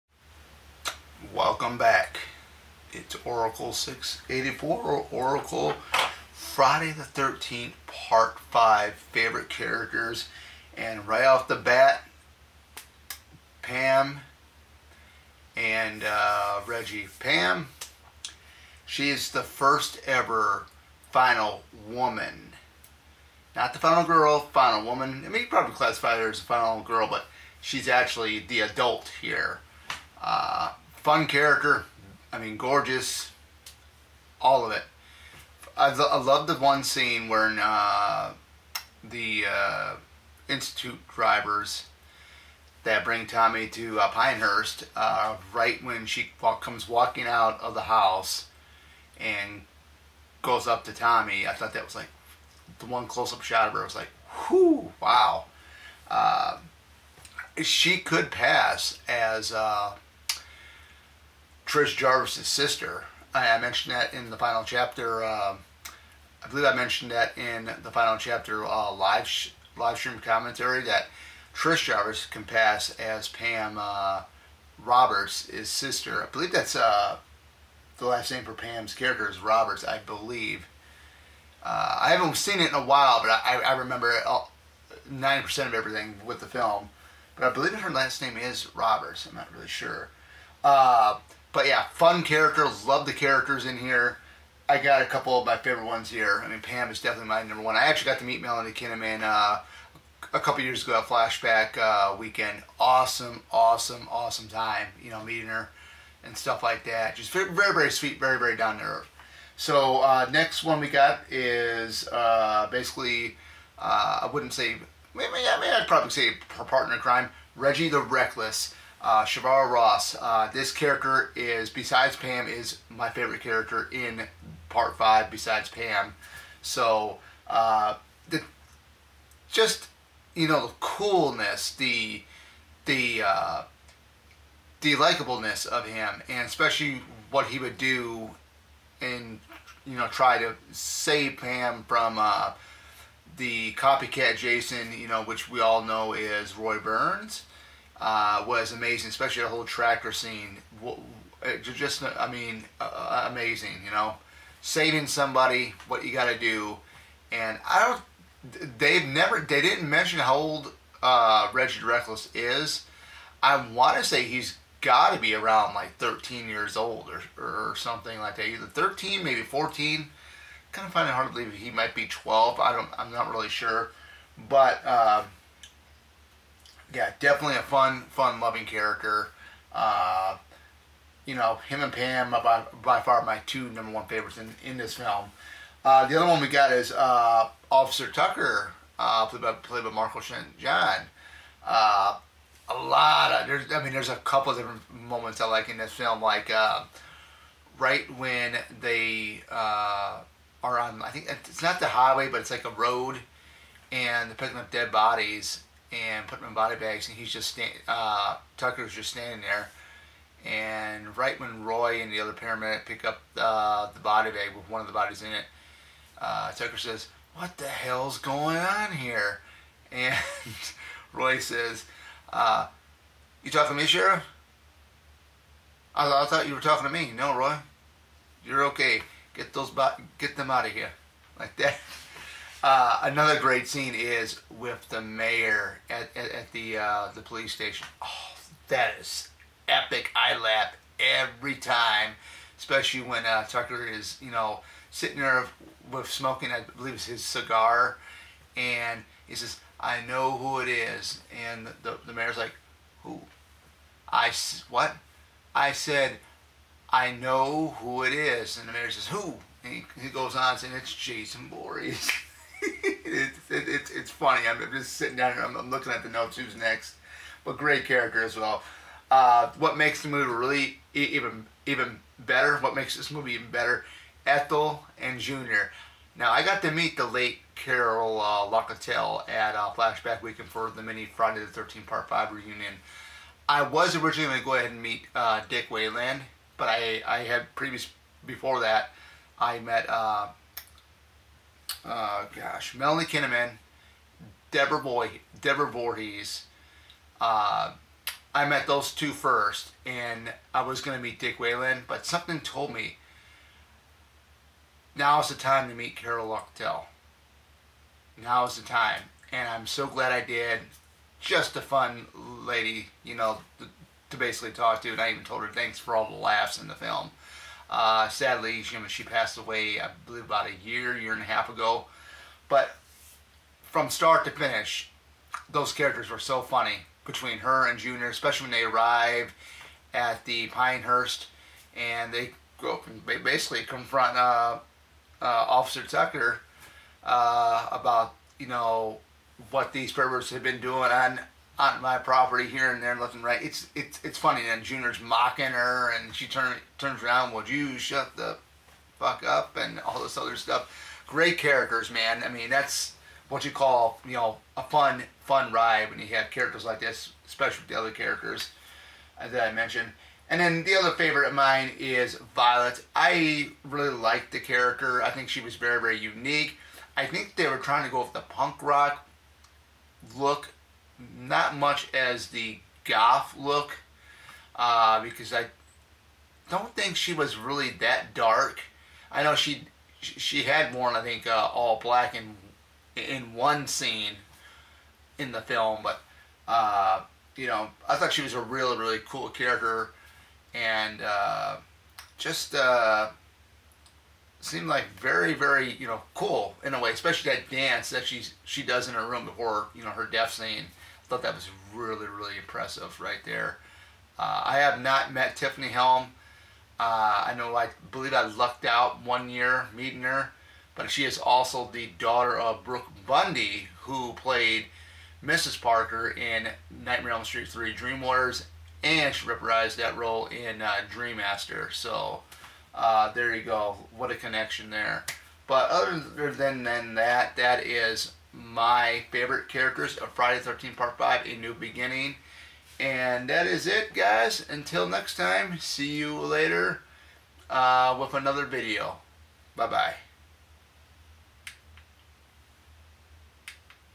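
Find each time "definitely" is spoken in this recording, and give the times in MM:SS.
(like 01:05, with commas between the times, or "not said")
01:37, 02:57.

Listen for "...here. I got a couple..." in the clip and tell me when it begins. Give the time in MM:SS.
01:33.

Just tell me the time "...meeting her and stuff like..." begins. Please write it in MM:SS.
01:45.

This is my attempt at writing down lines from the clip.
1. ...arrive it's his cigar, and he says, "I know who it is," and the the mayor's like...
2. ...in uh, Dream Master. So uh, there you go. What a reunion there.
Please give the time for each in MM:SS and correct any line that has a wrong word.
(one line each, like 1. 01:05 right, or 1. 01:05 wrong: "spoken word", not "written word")
1. 04:06 wrong: "believe", not "arrive"
2. 07:00 wrong: "connection", not "reunion".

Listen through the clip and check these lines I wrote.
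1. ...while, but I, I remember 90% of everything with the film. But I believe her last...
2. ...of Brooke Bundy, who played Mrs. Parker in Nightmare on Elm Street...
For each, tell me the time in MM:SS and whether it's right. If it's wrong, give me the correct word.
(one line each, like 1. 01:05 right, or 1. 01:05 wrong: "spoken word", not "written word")
1. 01:22 right
2. 06:52 right.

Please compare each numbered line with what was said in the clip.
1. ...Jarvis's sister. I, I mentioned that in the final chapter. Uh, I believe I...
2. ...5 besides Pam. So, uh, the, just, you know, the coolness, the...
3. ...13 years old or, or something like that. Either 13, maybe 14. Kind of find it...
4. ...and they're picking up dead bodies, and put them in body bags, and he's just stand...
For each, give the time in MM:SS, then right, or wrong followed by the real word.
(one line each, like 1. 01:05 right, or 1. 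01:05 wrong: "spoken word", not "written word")
1. 01:01 right
2. 02:04 right
3. 02:45 right
4. 03:23 right.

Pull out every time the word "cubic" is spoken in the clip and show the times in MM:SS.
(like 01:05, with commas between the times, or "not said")
not said.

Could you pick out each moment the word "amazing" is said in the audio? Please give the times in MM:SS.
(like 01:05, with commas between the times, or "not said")
02:28, 02:33.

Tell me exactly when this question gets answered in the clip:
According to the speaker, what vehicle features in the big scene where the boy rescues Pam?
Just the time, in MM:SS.
02:29.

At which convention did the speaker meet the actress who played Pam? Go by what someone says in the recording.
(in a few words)
Flashback Weekend.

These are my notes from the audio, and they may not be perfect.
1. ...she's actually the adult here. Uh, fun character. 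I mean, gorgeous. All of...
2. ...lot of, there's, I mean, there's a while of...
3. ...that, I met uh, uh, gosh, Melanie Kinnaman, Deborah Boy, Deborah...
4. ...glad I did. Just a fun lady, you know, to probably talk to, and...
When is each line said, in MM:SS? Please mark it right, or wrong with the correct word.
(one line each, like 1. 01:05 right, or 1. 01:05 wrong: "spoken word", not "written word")
1. 00:27 right
2. 03:12 wrong: "couple", not "while"
3. 04:48 right
4. 05:09 wrong: "basically", not "probably".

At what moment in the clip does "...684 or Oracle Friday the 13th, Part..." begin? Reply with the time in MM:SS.
00:03.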